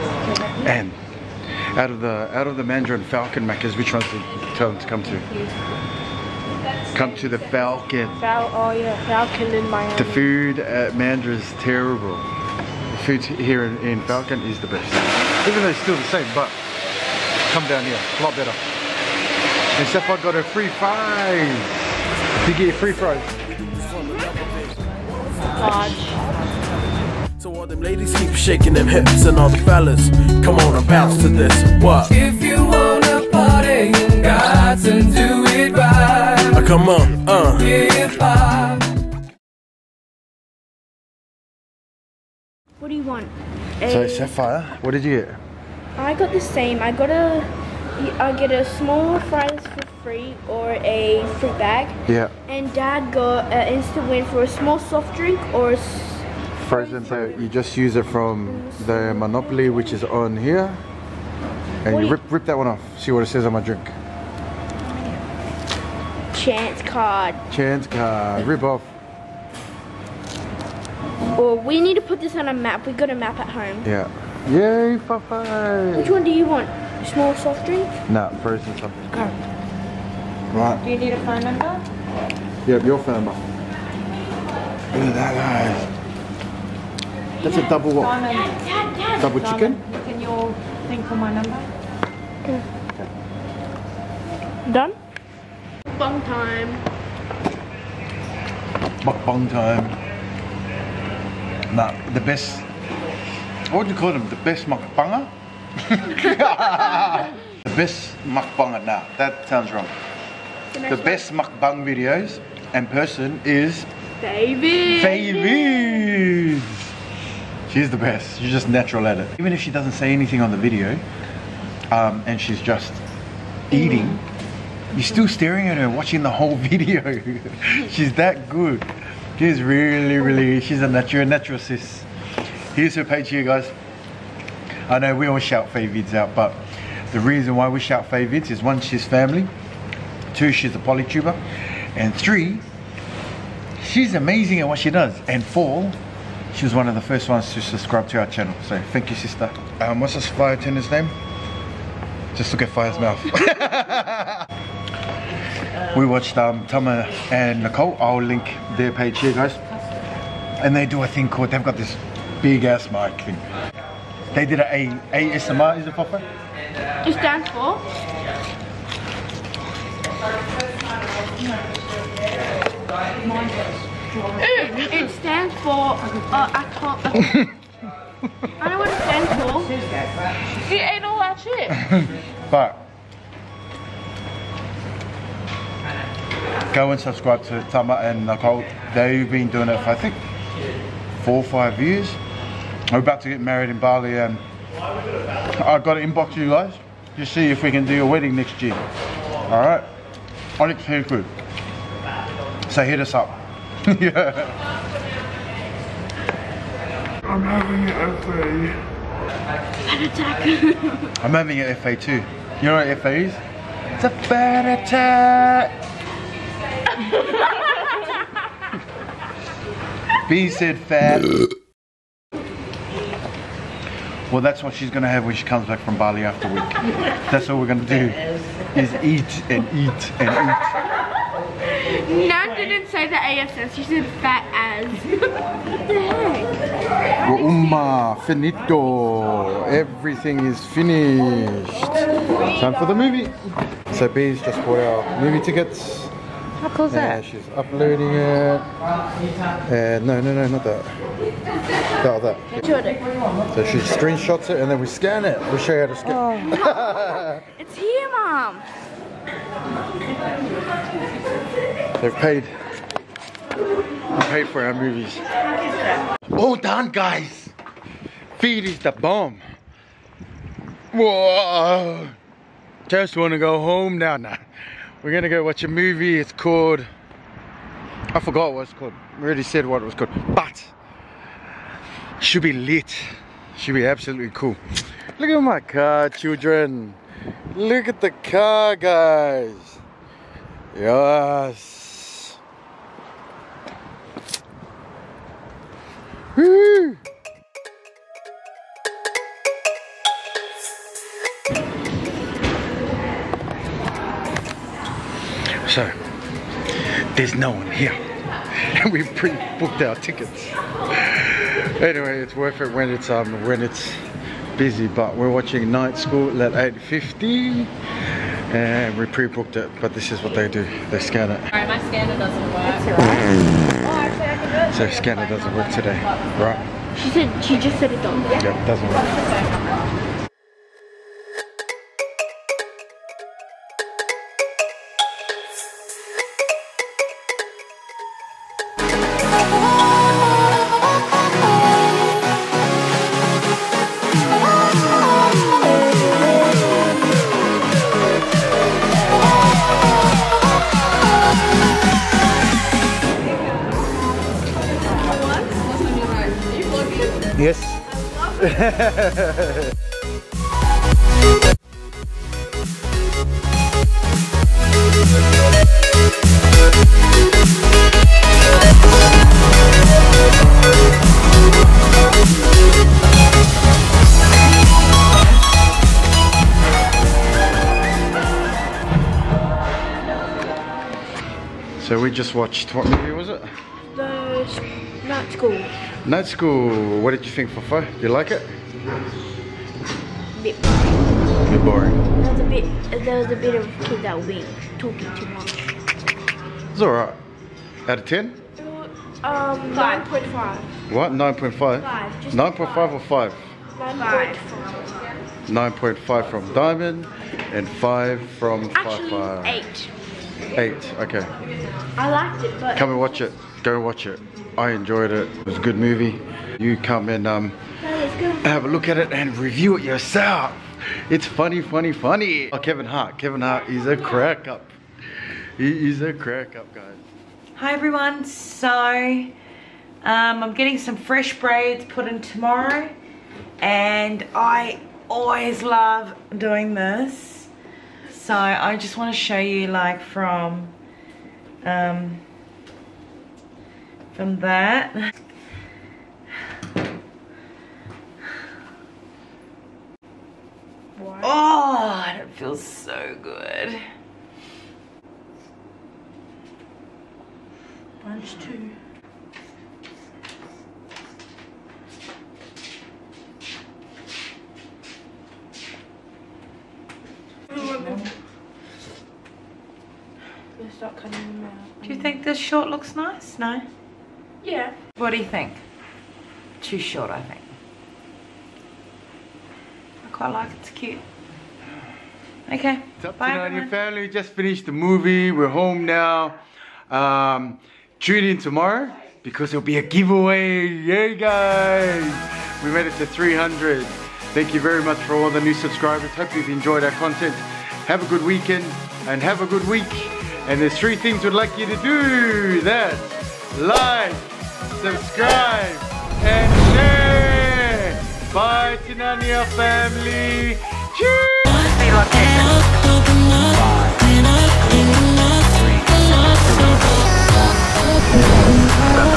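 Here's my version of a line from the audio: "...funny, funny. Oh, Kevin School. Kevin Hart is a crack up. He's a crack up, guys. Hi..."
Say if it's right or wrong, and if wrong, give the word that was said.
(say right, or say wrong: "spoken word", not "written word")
wrong: "Hart", not "School".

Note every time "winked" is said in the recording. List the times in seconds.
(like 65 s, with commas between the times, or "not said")
394 s.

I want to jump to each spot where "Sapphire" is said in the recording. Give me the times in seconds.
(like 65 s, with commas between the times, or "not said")
44 s.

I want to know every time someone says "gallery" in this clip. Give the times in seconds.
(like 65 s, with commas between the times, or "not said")
not said.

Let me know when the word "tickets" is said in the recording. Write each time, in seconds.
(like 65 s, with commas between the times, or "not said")
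245 s, 309 s.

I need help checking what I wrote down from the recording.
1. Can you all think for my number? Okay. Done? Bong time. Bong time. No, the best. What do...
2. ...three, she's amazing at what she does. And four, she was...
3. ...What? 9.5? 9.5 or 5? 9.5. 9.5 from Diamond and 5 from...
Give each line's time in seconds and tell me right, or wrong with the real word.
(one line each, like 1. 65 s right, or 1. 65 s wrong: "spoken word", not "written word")
1. 90 s right
2. 142 s right
3. 400 s right.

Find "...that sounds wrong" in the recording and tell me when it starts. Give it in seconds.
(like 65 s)
109 s.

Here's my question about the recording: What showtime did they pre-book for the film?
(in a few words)
8.50.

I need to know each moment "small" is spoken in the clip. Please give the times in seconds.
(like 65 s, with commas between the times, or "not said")
48 s, 54 s, 77 s.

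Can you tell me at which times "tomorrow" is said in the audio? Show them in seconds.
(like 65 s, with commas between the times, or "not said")
432 s, 488 s.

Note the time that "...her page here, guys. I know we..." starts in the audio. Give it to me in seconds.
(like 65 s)
132 s.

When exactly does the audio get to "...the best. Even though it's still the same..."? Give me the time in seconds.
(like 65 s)
14 s.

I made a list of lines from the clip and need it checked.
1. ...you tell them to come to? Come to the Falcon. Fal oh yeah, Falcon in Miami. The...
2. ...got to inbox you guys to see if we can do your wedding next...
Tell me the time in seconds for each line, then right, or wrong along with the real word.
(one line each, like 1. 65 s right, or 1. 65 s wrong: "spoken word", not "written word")
1. 4 s right
2. 195 s right.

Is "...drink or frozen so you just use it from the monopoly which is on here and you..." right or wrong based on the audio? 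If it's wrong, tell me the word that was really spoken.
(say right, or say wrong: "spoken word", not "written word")
right.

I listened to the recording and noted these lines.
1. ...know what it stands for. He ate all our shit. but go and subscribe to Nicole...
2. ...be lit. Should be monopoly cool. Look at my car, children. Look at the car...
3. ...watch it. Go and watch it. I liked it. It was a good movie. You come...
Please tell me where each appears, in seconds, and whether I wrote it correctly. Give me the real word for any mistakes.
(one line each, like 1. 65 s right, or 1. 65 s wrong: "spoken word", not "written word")
1. 178 s wrong: "Tama", not "Nicole"
2. 282 s wrong: "absolutely", not "monopoly"
3. 412 s wrong: "enjoyed", not "liked".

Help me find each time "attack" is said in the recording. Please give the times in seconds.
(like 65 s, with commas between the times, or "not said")
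210 s, 214 s.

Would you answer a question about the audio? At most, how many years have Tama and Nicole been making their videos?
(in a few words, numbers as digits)
5.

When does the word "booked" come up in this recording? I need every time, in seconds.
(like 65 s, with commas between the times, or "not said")
309 s, 319 s.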